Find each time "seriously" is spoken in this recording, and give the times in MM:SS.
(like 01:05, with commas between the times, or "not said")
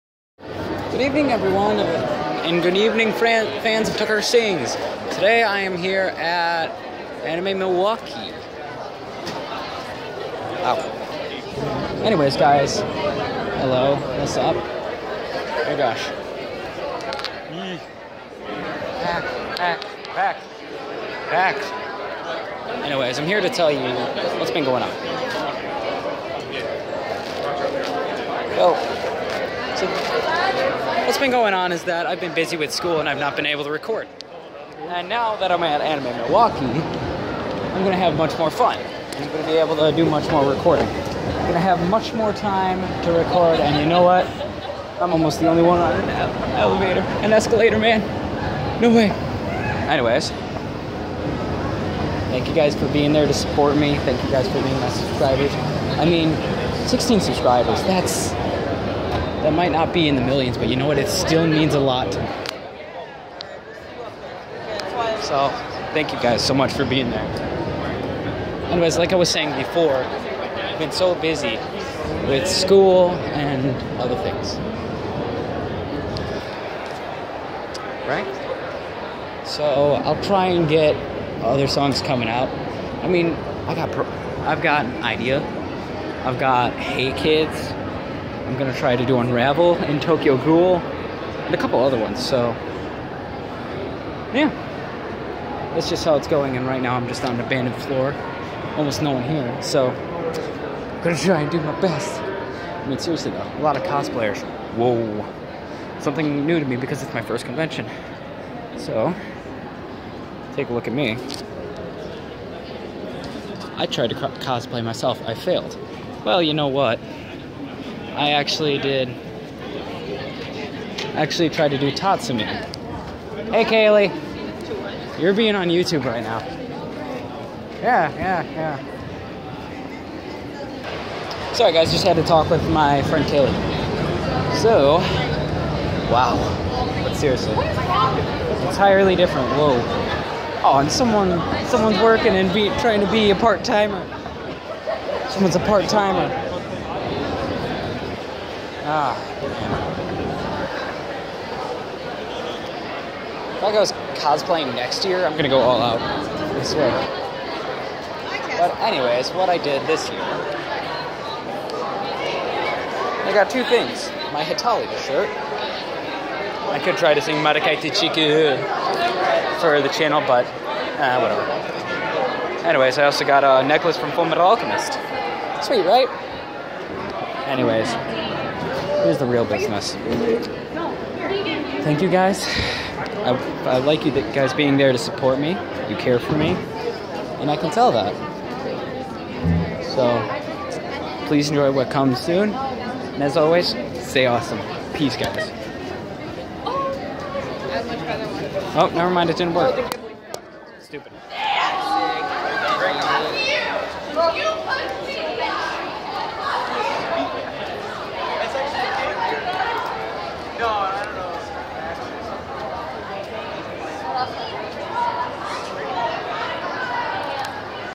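01:42, 02:17.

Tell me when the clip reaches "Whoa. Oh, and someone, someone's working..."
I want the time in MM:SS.
02:19.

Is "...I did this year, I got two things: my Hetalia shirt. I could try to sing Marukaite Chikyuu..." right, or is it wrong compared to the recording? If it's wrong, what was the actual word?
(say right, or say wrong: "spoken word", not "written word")
right.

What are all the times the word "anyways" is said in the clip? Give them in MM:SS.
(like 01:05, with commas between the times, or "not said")
00:12, 00:22, 00:49, 01:08, 02:38, 02:52, 02:57.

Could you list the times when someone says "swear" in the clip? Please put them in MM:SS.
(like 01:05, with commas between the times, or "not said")
02:36.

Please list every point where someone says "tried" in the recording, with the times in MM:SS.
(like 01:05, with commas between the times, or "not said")
01:53, 02:01.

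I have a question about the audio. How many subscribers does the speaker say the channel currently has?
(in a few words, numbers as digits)
16.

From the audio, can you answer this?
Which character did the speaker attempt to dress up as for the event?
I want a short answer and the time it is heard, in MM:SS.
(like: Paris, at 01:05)
Tatsumi, at 02:01.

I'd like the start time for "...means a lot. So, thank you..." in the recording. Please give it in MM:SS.
01:01.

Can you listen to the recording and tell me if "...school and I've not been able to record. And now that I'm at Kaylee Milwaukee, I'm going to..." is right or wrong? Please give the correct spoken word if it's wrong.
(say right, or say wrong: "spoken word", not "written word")
wrong: "Anime", not "Kaylee".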